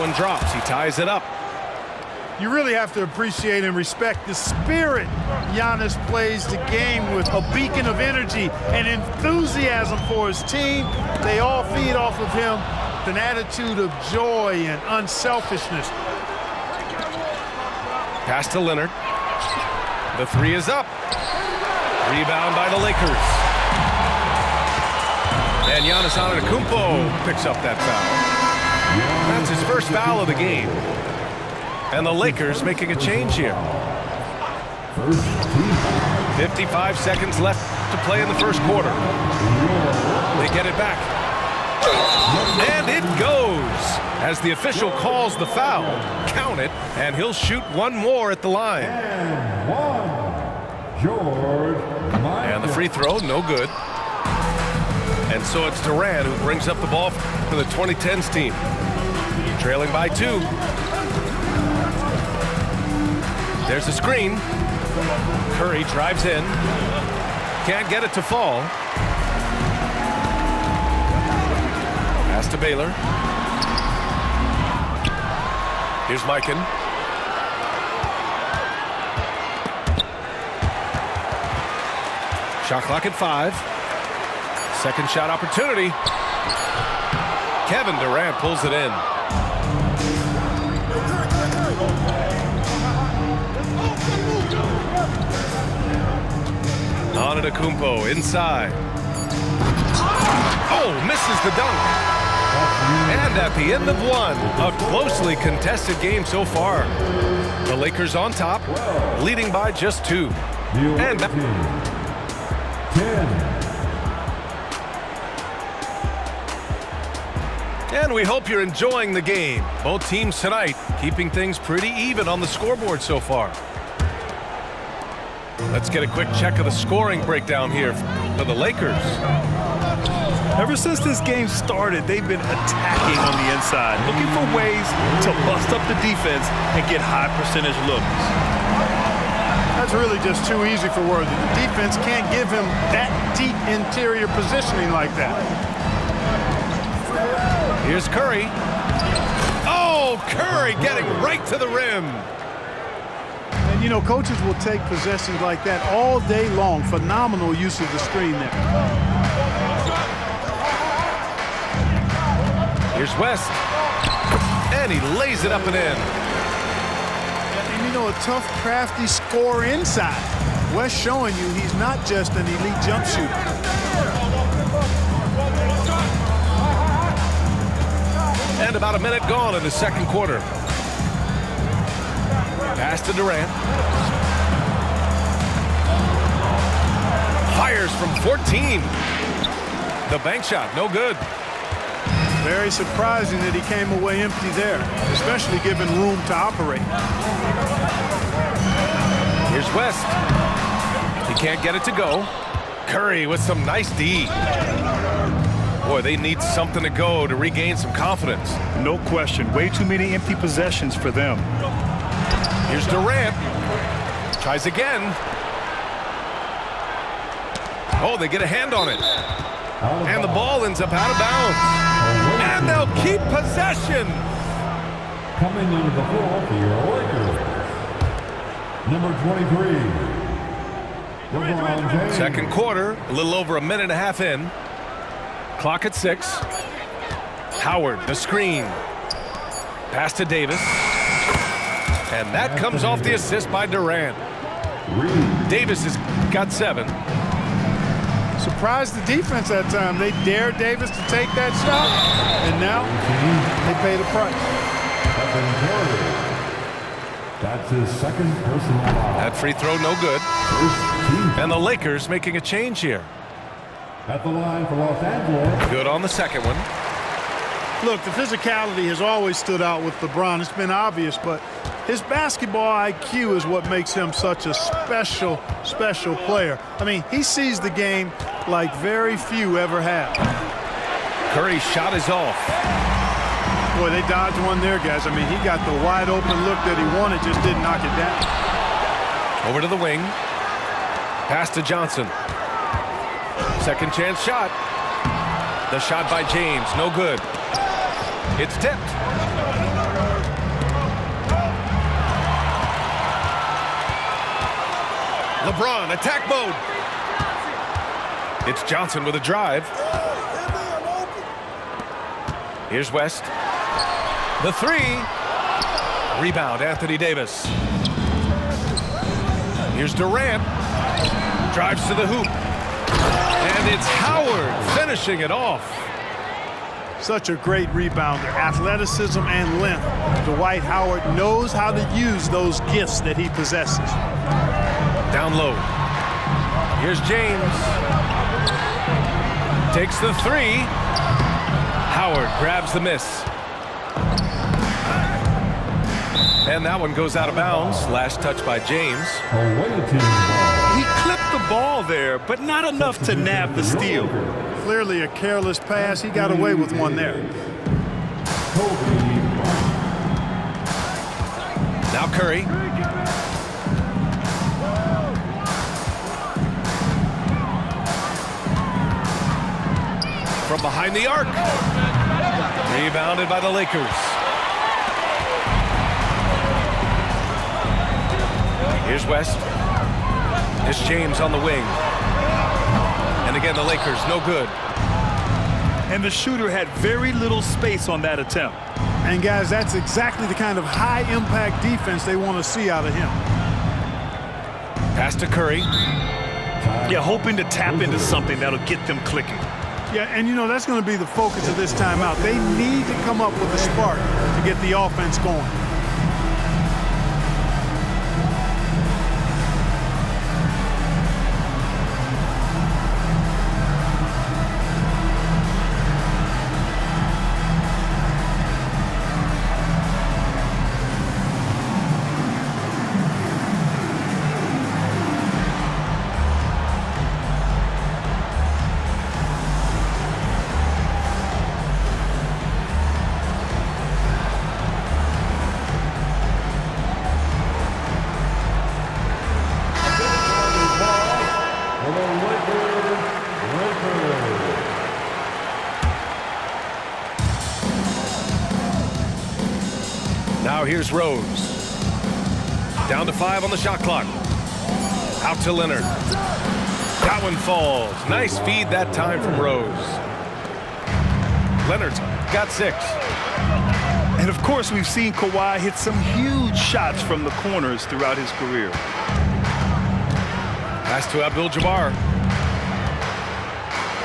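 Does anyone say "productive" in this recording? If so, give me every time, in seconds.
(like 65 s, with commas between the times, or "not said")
not said.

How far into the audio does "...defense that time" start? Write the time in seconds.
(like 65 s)
249 s.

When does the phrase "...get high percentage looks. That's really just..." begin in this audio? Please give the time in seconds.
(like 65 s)
136 s.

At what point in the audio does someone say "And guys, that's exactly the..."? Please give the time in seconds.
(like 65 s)
389 s.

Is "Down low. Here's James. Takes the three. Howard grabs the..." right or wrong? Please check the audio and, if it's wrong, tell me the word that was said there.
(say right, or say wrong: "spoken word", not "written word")
right.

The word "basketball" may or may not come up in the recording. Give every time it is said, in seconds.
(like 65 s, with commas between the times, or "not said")
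272 s.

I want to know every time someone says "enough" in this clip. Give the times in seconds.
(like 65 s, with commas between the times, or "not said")
352 s.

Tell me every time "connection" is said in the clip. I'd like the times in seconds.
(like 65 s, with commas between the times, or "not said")
not said.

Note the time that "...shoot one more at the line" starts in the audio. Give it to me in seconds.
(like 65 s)
47 s.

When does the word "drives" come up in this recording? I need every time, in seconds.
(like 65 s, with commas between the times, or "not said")
65 s, 309 s, 321 s.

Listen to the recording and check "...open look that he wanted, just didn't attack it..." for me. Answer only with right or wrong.
wrong.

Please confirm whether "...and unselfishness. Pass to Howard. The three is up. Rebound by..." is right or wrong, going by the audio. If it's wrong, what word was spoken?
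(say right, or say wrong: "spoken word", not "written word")
wrong: "Leonard", not "Howard".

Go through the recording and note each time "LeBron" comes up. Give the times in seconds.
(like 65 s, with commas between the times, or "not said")
269 s, 305 s.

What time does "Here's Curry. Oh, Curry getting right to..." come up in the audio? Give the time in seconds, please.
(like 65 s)
147 s.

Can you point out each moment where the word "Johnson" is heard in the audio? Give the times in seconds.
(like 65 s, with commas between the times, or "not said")
291 s, 308 s.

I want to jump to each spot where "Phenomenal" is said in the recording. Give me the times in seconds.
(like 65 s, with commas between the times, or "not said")
156 s.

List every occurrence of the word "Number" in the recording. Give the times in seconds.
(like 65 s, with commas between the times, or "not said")
231 s.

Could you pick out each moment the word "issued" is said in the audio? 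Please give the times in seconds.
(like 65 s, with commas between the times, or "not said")
not said.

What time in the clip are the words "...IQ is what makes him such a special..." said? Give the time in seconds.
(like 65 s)
272 s.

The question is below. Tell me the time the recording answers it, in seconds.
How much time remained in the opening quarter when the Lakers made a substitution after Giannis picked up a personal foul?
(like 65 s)
36 s.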